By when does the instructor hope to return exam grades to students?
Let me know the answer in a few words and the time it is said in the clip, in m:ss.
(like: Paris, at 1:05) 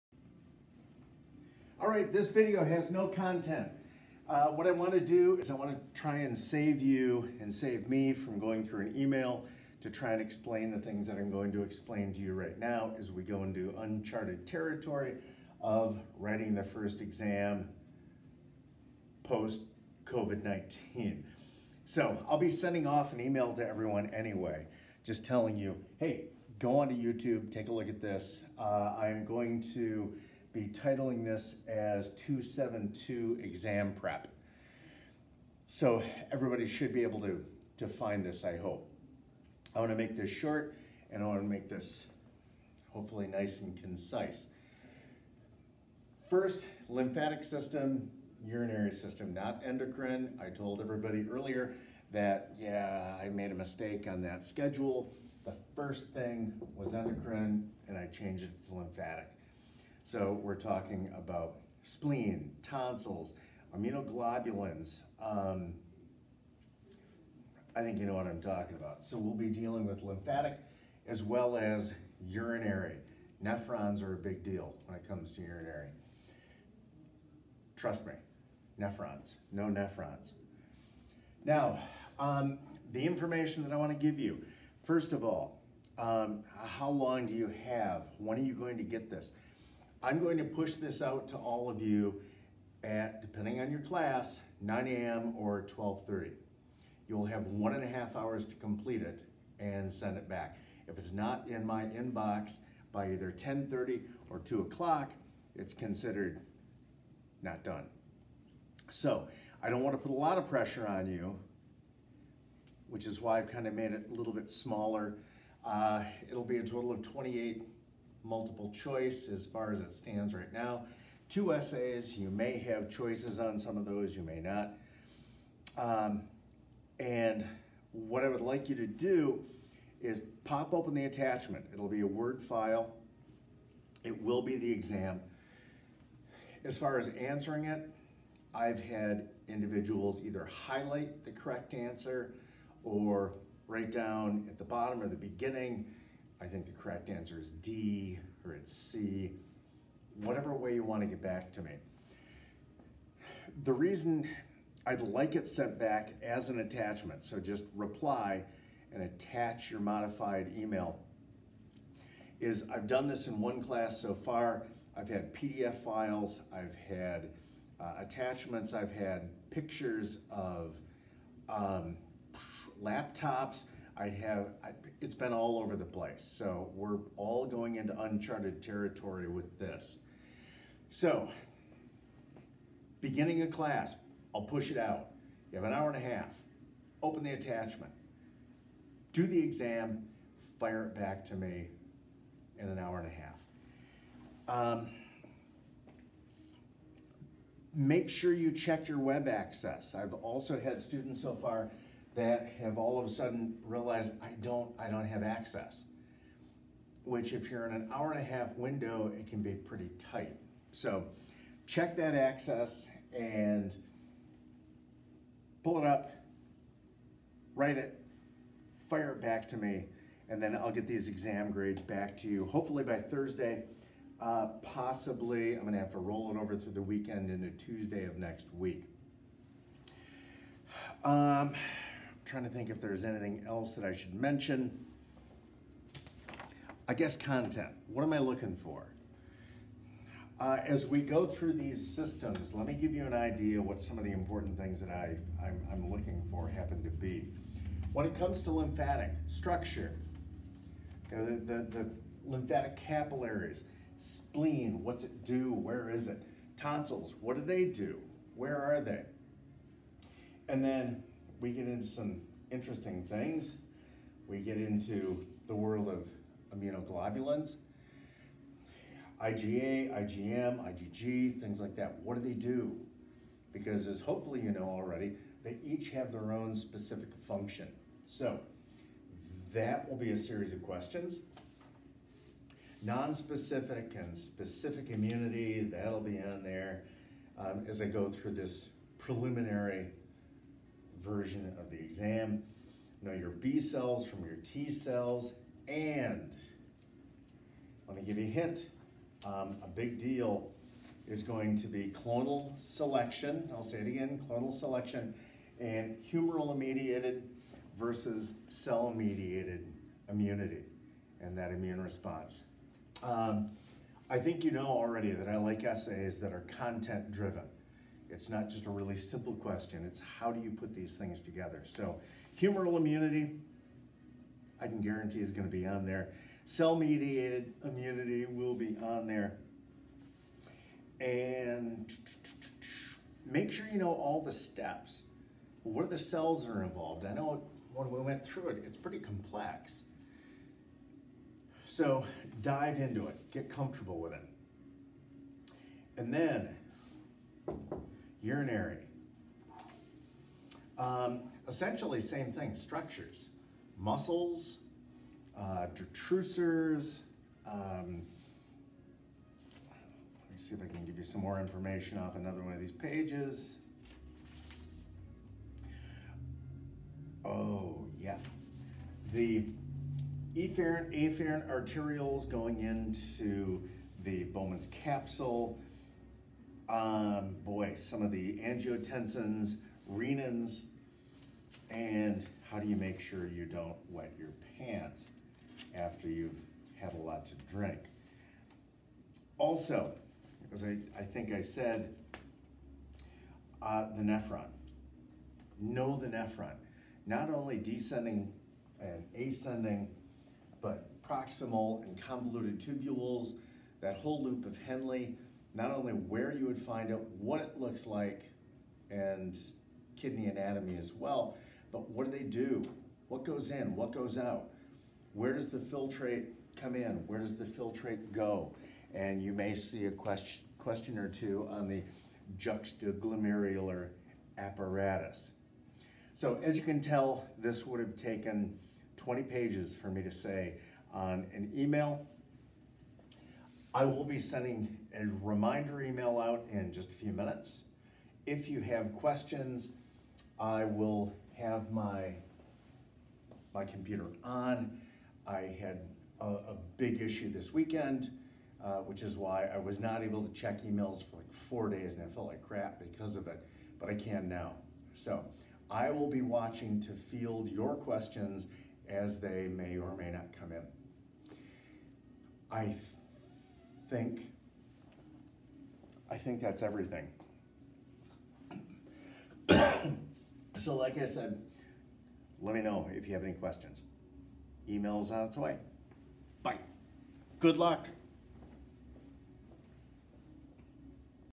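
Thursday, at 3:42.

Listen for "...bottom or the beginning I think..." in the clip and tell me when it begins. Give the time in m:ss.
2:24.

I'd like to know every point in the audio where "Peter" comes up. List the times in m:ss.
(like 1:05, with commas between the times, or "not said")
not said.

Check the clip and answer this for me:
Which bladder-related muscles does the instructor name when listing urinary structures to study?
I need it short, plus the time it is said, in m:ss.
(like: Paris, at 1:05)
detrusors, at 5:55.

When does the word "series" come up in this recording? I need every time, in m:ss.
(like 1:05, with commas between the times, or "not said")
4:40.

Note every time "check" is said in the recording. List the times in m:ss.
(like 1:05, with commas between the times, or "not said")
3:18, 3:31, 7:30.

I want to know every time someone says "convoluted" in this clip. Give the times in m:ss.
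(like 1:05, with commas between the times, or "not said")
6:42.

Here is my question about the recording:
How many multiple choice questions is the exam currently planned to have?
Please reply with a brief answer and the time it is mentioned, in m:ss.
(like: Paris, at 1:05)
28, at 1:57.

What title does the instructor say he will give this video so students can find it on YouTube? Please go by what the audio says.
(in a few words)
272 exam prep.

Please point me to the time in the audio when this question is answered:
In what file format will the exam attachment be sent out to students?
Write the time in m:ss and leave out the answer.
2:12.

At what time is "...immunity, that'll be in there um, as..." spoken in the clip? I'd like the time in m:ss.
4:44.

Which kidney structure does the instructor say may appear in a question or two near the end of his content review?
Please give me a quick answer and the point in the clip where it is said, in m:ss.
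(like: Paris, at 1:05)
juxtaglomerular apparatus, at 7:02.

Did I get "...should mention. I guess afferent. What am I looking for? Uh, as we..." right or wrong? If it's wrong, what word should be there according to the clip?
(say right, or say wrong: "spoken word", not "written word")
wrong: "content", not "afferent".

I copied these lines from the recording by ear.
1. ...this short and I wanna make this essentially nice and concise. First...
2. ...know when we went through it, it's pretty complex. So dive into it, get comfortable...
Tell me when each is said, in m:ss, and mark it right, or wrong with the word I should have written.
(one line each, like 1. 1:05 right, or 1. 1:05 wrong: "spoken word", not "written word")
1. 0:40 wrong: "hopefully", not "essentially"
2. 5:37 right.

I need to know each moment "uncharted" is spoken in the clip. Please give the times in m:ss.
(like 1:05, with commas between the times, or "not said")
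0:13, 2:57.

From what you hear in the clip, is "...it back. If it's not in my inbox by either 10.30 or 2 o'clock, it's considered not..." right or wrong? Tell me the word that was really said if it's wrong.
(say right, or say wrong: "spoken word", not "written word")
right.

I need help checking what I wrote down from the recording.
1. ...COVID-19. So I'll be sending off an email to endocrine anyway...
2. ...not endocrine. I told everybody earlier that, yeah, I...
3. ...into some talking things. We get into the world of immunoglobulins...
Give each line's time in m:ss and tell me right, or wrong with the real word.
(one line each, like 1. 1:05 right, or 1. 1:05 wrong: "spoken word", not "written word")
1. 0:20 wrong: "everyone", not "endocrine"
2. 0:49 right
3. 4:21 wrong: "interesting", not "talking".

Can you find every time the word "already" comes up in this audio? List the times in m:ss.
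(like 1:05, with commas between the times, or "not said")
4:34, 5:14.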